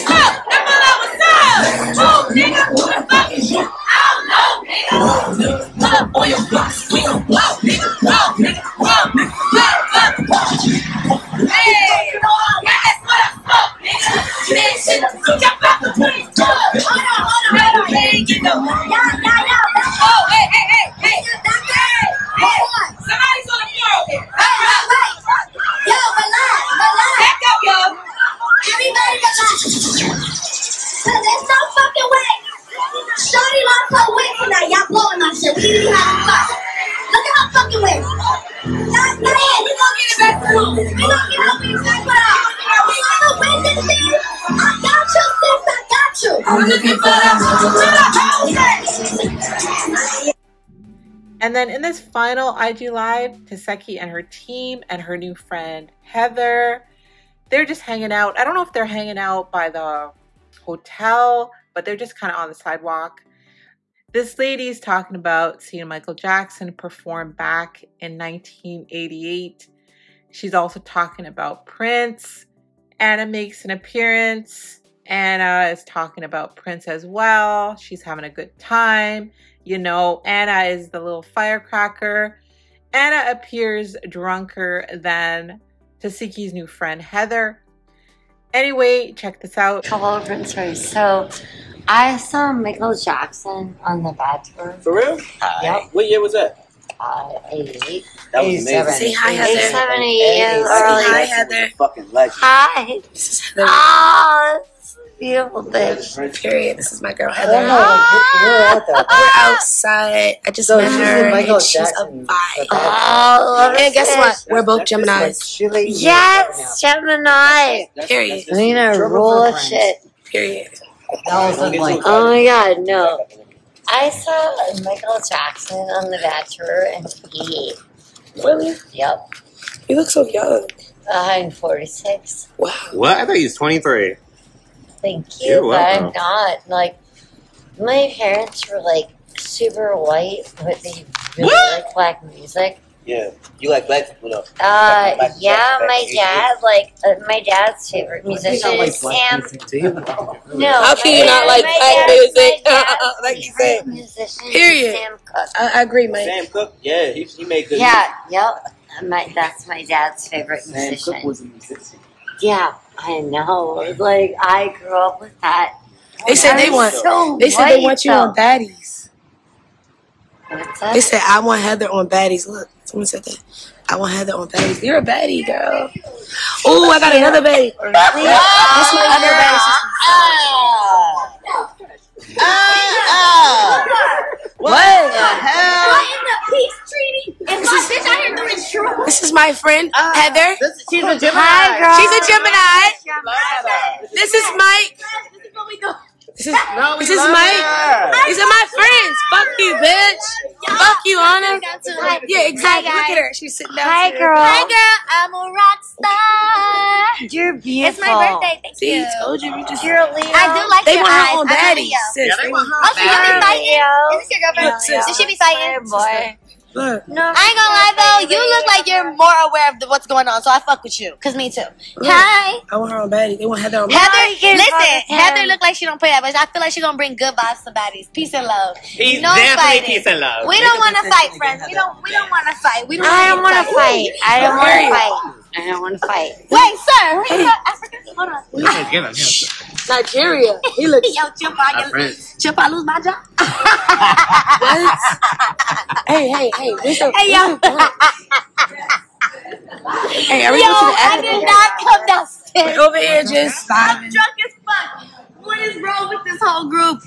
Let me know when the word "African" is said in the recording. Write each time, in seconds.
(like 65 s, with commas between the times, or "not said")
237 s.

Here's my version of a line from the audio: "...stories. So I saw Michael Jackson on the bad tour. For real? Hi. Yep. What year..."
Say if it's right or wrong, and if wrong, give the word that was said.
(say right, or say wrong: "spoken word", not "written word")
right.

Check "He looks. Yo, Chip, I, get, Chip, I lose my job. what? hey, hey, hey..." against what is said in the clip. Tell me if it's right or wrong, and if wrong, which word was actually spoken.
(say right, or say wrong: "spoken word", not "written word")
right.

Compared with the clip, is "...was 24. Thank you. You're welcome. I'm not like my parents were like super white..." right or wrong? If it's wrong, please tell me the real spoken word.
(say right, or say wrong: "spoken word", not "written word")
wrong: "23", not "24".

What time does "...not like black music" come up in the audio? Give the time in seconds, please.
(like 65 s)
151 s.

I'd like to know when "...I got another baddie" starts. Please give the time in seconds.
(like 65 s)
176 s.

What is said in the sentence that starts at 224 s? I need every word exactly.
Heather, listen, Heather look like she don't play that, much.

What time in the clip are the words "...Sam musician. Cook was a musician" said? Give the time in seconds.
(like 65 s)
160 s.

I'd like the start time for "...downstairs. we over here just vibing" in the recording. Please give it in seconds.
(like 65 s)
252 s.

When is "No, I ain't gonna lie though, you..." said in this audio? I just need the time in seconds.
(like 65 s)
217 s.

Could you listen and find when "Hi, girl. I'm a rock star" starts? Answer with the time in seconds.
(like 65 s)
204 s.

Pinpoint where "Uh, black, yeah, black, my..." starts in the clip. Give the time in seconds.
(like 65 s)
144 s.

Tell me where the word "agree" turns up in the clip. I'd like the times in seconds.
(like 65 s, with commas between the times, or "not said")
155 s.